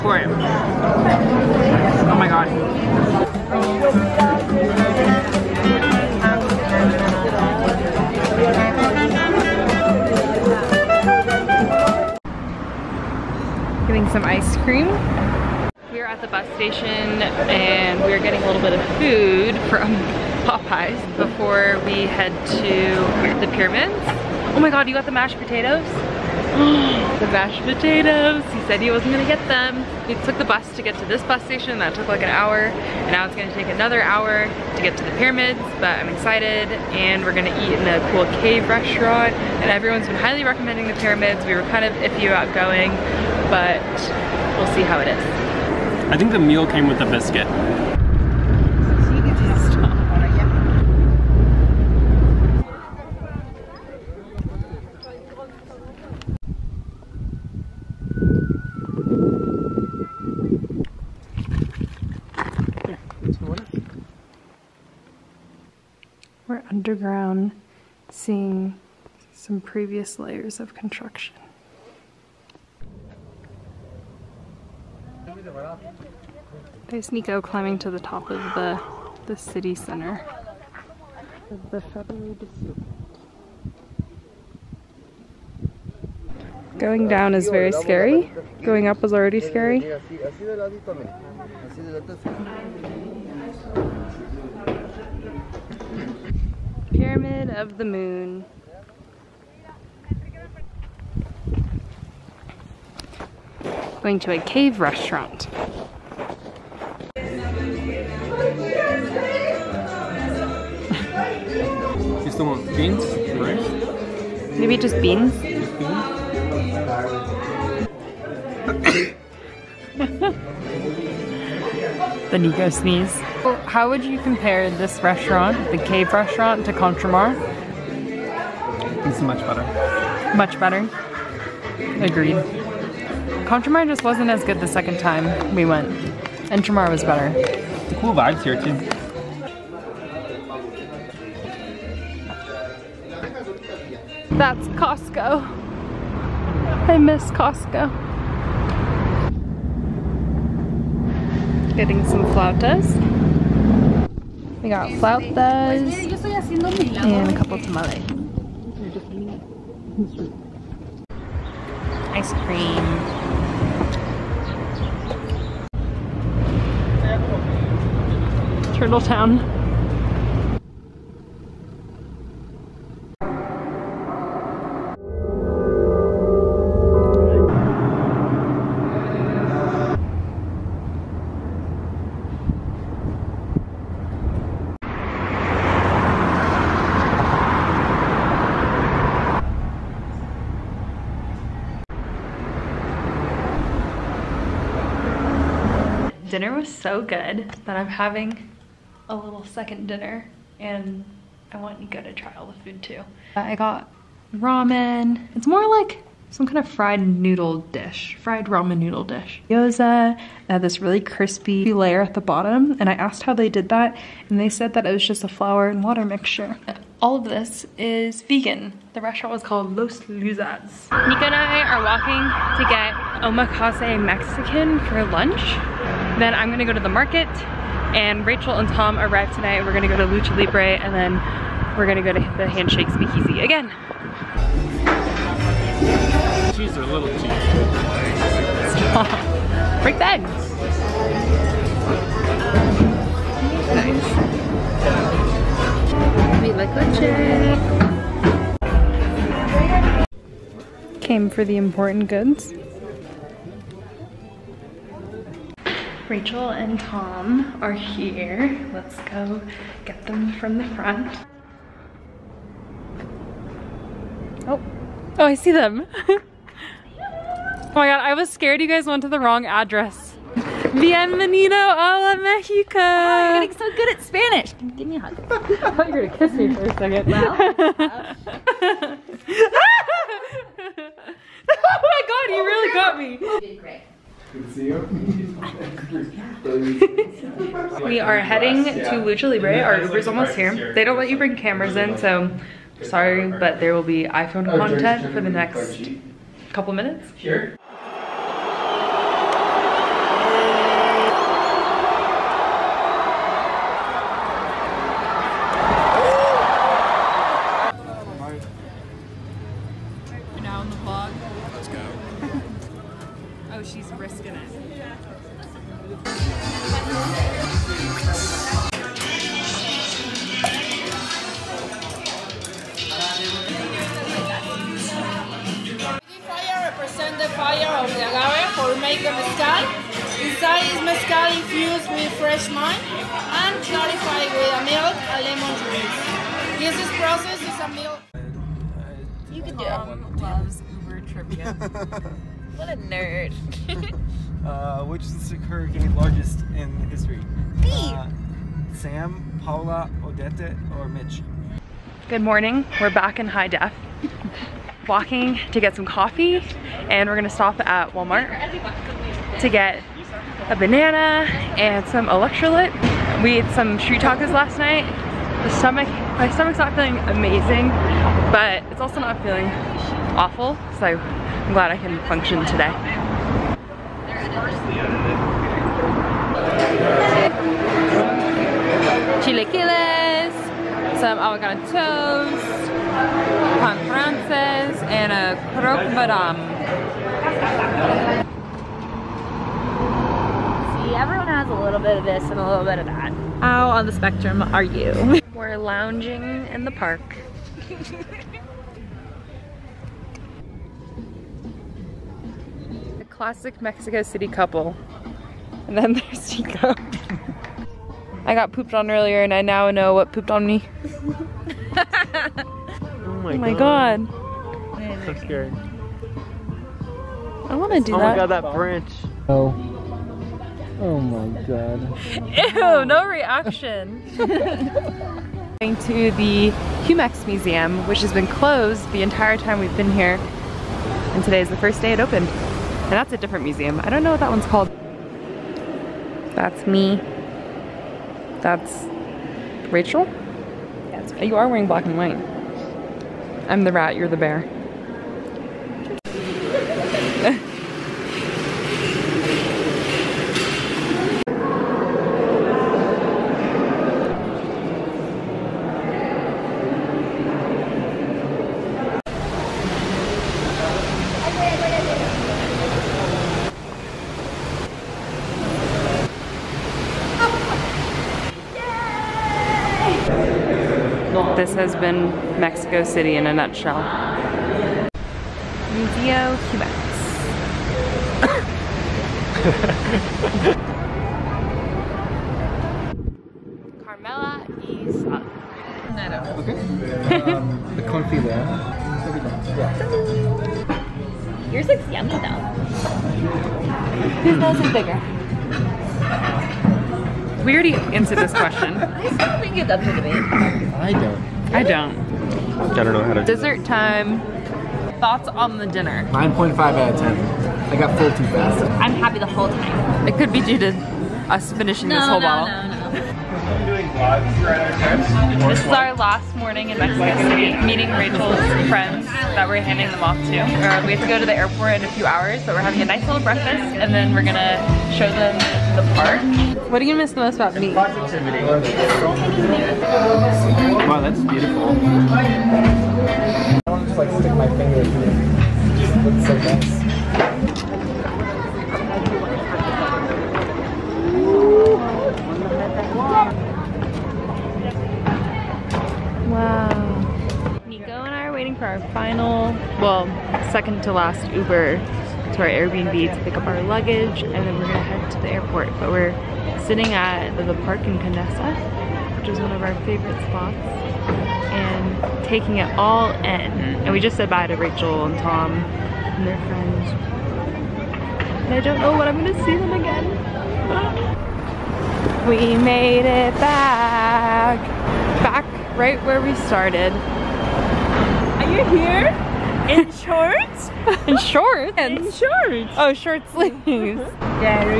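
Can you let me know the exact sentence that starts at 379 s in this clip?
Chilaquiles, some avocado toast, pan frances, and a croque madame.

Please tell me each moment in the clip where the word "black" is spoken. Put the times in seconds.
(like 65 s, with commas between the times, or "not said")
441 s.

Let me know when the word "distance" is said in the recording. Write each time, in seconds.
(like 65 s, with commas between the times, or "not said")
not said.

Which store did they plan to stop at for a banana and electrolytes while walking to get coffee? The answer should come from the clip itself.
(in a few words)
Walmart.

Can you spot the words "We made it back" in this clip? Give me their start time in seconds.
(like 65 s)
572 s.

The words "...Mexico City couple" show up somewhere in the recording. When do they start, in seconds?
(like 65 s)
403 s.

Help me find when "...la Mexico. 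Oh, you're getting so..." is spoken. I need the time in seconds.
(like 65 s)
272 s.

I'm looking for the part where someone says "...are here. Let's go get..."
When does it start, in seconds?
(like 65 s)
257 s.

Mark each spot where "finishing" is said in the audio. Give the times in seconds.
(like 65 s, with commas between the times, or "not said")
511 s.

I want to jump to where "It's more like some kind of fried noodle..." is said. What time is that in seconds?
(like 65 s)
205 s.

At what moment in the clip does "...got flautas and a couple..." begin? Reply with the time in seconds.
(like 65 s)
154 s.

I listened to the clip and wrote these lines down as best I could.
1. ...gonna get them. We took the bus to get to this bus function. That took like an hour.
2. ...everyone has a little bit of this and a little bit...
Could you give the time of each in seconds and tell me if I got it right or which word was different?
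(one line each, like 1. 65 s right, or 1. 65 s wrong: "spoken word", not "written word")
1. 29 s wrong: "station", not "function"
2. 390 s right.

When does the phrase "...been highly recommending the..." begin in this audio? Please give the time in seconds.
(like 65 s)
40 s.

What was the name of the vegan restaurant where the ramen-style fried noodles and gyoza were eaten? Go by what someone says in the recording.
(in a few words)
Los Luzas.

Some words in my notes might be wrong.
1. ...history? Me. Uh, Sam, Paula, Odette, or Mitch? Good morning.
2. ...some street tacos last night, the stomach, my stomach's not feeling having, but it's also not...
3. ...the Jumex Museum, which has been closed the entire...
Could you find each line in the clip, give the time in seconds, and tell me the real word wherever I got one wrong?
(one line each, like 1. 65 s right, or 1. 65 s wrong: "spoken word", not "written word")
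1. 346 s right
2. 363 s wrong: "amazing", not "having"
3. 426 s right.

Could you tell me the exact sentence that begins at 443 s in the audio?
I'm the rat, you're the bear.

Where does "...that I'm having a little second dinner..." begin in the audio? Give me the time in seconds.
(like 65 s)
197 s.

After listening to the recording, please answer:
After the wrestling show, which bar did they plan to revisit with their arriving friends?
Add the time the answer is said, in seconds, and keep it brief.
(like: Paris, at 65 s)
Handshake Speakeasy, at 232 s.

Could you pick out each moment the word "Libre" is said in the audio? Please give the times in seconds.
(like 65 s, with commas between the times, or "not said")
230 s, 289 s.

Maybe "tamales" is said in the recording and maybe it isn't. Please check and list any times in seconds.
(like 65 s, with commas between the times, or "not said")
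157 s.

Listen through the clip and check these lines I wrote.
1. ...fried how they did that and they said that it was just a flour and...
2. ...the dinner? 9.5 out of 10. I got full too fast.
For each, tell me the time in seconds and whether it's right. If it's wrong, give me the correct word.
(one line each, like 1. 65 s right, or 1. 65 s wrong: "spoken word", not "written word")
1. 212 s wrong: "asked", not "fried"
2. 505 s right.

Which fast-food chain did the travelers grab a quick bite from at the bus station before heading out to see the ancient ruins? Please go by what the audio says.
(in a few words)
Popeyes.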